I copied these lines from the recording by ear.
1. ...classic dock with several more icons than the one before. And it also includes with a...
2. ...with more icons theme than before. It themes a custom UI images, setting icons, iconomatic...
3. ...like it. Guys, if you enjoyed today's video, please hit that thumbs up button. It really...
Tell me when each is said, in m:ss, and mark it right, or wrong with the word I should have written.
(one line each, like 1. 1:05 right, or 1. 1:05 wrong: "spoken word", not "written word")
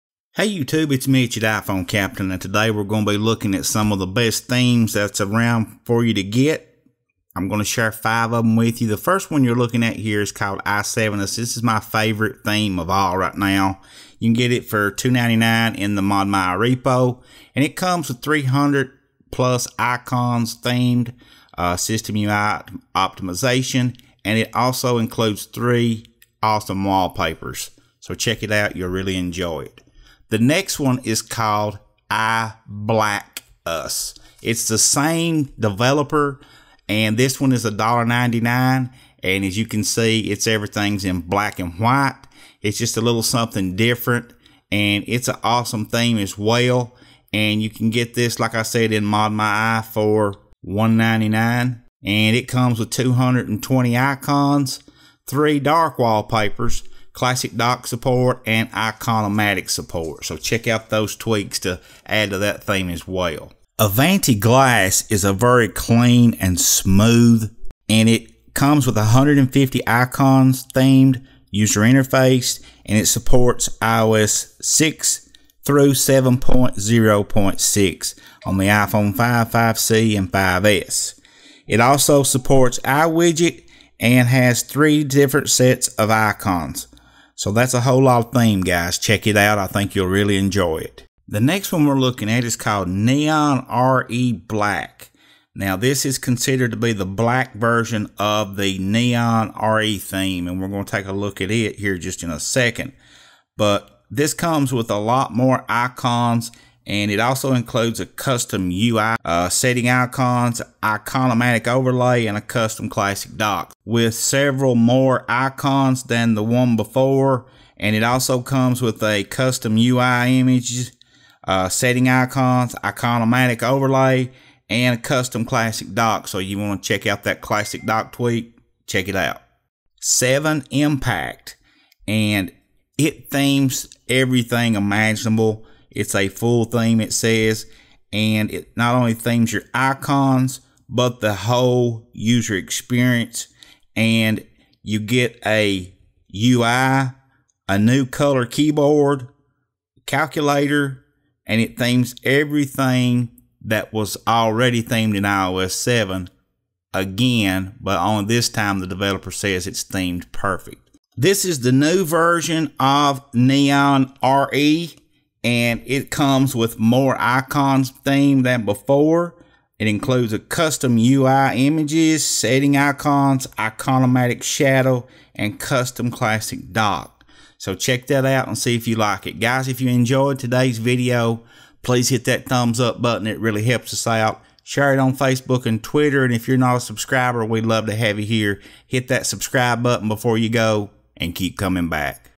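1. 1:52 wrong: "comes", not "includes"
2. 2:46 wrong: "includes", not "themes"
3. 2:58 right.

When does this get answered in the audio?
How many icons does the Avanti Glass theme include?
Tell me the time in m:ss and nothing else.
1:08.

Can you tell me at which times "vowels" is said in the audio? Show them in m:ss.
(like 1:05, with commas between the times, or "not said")
not said.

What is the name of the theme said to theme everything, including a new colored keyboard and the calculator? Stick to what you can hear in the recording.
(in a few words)
Seven Impact.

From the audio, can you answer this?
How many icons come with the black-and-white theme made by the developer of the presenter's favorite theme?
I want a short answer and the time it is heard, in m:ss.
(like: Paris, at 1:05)
220, at 0:52.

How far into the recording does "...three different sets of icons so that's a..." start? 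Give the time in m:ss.
1:24.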